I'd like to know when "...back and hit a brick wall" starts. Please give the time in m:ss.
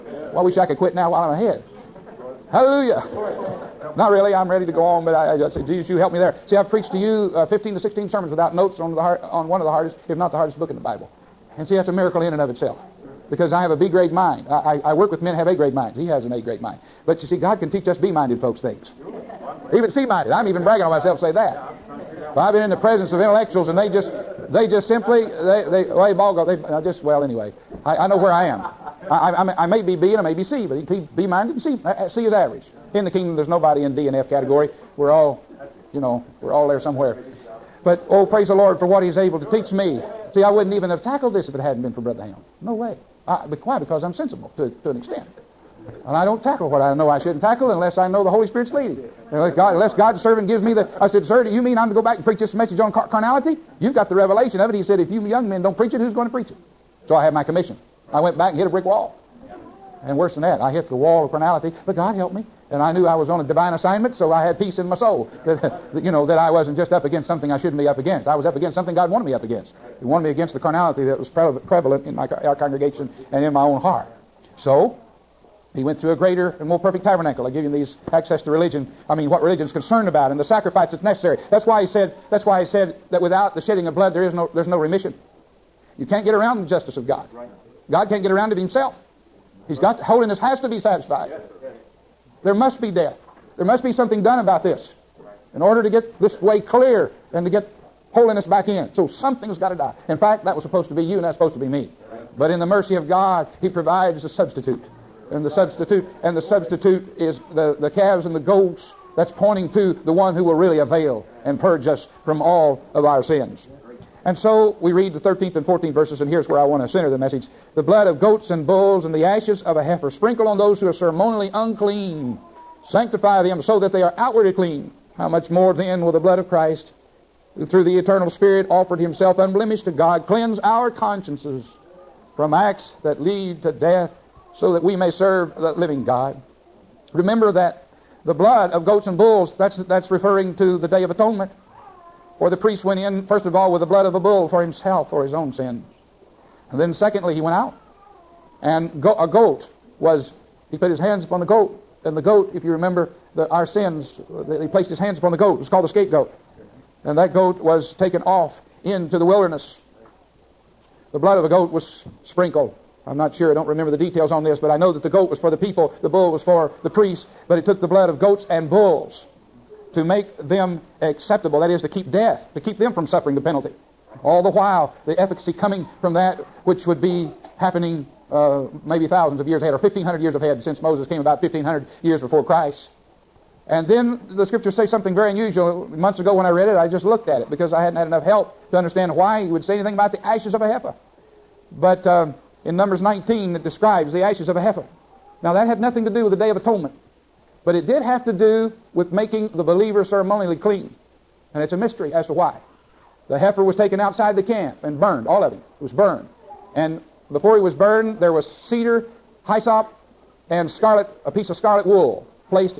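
0:58.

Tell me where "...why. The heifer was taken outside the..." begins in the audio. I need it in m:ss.
3:22.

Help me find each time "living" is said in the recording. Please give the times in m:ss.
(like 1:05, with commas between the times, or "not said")
2:15.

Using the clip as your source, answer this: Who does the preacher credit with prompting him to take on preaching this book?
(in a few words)
Brother Helm.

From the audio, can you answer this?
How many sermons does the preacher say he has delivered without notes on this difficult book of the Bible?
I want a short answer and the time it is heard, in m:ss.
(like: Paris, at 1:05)
15 to 16, at 0:07.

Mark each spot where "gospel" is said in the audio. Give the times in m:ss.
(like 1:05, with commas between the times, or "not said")
not said.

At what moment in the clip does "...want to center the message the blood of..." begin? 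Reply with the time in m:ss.
1:56.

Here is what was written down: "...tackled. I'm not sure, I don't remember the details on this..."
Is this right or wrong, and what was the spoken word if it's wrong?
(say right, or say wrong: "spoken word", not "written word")
wrong: "sprinkled", not "tackled".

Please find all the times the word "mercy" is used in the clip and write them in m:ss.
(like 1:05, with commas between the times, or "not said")
1:42.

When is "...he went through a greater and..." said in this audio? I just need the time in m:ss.
1:15.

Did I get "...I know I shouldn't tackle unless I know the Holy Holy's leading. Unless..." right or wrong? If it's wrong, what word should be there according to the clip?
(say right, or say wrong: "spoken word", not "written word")
wrong: "Spirit", not "Holy".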